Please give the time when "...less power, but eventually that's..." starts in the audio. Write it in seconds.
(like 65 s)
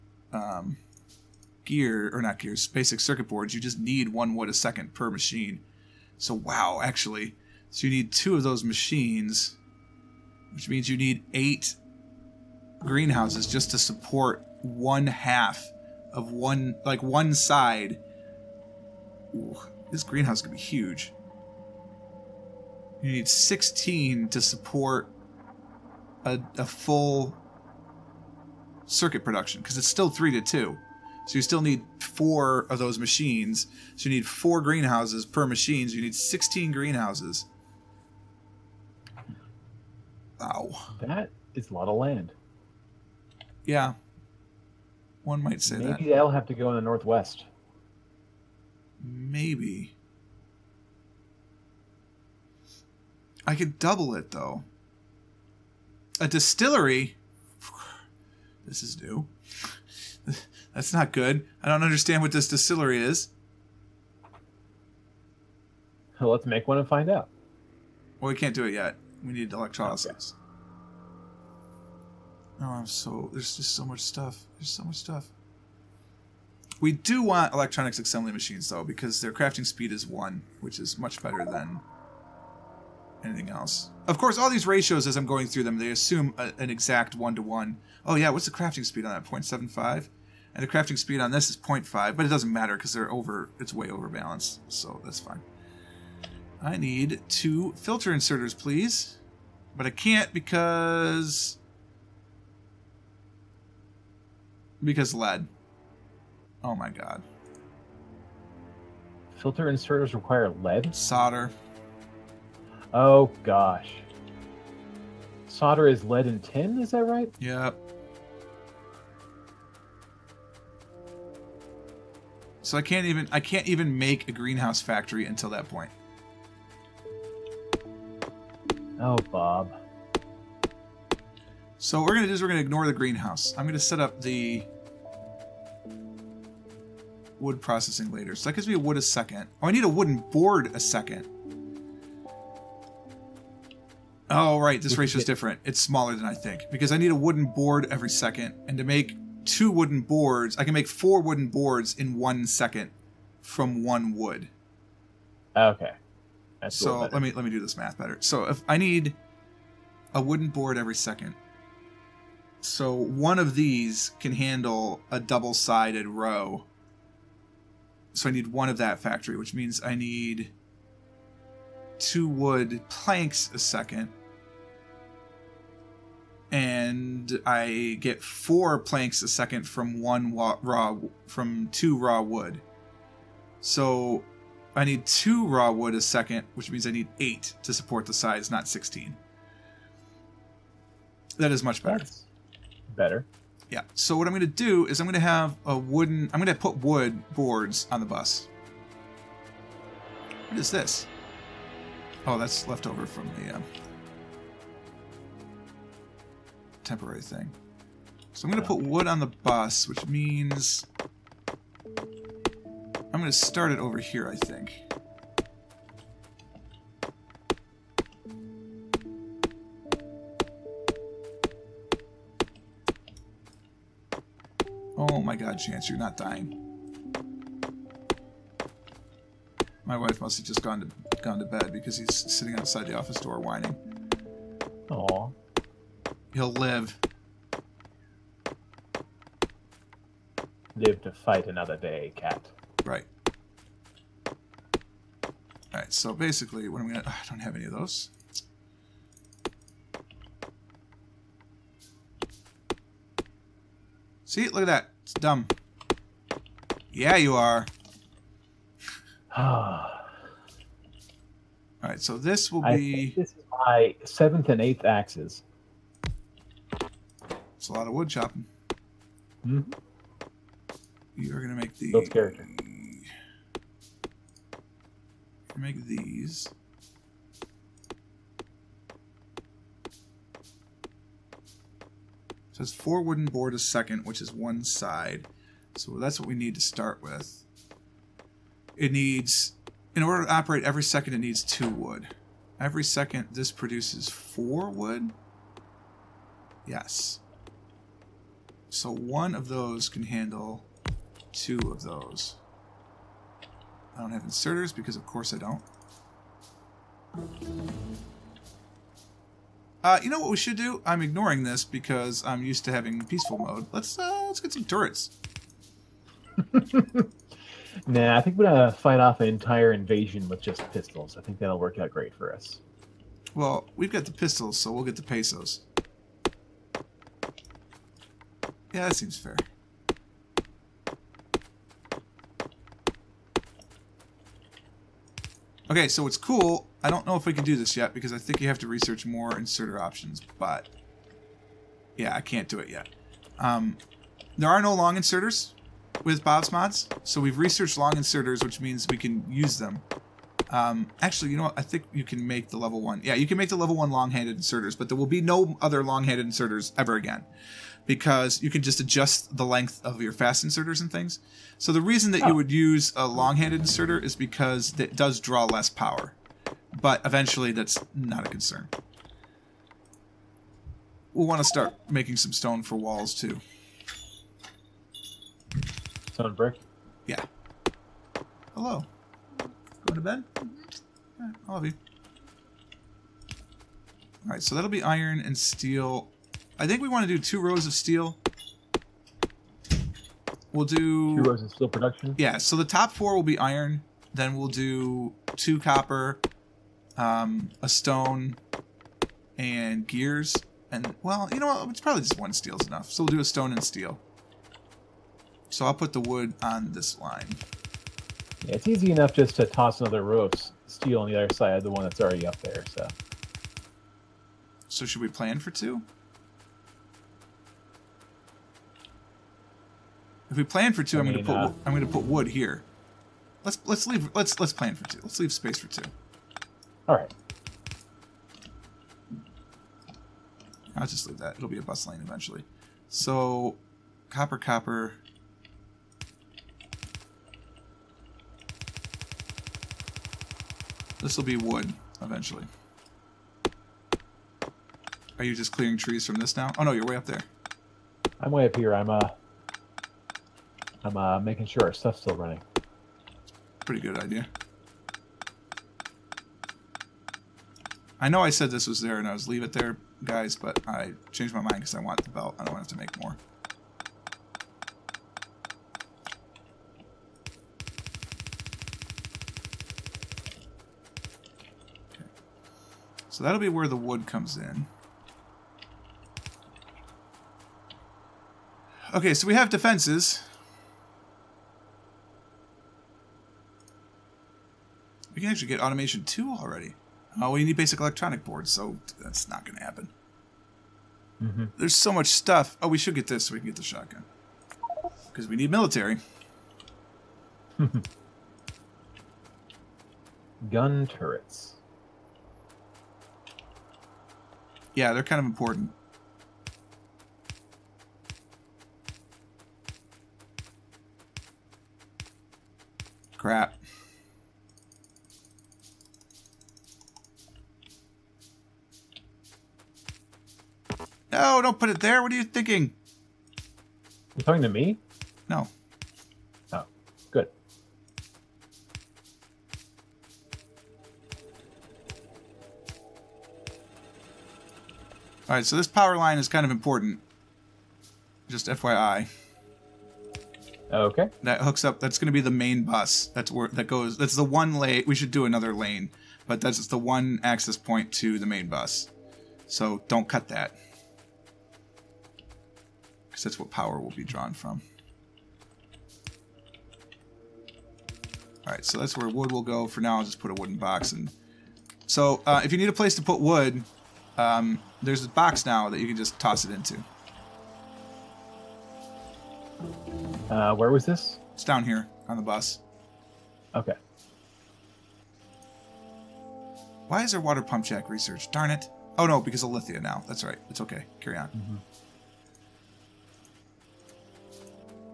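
365 s.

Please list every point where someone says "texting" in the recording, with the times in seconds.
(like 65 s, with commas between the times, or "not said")
not said.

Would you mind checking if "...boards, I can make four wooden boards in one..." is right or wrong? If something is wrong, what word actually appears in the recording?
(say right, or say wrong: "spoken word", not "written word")
right.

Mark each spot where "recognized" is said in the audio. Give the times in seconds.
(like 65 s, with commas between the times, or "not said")
not said.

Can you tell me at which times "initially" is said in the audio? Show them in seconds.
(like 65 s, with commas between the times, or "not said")
not said.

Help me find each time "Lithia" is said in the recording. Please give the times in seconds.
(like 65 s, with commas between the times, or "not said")
579 s.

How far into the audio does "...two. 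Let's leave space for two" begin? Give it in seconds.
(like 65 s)
424 s.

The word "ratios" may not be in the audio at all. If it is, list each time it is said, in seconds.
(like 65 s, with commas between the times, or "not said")
84 s, 144 s.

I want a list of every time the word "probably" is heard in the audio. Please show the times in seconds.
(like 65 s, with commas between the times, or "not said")
401 s.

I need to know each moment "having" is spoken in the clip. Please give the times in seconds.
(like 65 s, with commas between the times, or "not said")
312 s.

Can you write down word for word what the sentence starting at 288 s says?
It needs, in order to operate every second, it needs two wood.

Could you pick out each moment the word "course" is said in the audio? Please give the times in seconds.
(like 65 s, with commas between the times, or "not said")
84 s, 305 s.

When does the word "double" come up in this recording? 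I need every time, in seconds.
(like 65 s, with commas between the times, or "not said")
53 s, 165 s.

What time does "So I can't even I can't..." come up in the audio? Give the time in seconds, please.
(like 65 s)
122 s.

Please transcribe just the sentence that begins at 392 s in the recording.
Yeah, so the top four will be iron.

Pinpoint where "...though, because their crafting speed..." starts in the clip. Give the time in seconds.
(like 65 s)
78 s.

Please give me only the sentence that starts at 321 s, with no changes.
I think that'll work out great for us.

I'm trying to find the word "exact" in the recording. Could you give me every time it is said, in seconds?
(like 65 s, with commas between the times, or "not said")
86 s.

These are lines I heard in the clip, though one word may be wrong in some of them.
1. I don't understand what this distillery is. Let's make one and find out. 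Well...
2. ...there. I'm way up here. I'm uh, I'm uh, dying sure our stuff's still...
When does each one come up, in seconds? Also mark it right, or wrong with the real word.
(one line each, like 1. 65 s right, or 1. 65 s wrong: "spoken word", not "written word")
1. 61 s right
2. 447 s wrong: "making", not "dying".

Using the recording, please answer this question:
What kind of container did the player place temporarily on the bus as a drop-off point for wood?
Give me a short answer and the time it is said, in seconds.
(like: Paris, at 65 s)
wooden box, at 560 s.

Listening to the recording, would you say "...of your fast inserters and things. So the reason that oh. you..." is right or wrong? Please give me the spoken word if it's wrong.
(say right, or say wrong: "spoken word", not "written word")
right.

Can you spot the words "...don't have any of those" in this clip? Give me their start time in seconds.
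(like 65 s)
247 s.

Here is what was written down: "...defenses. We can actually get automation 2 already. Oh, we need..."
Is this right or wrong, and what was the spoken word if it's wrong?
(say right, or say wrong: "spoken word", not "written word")
right.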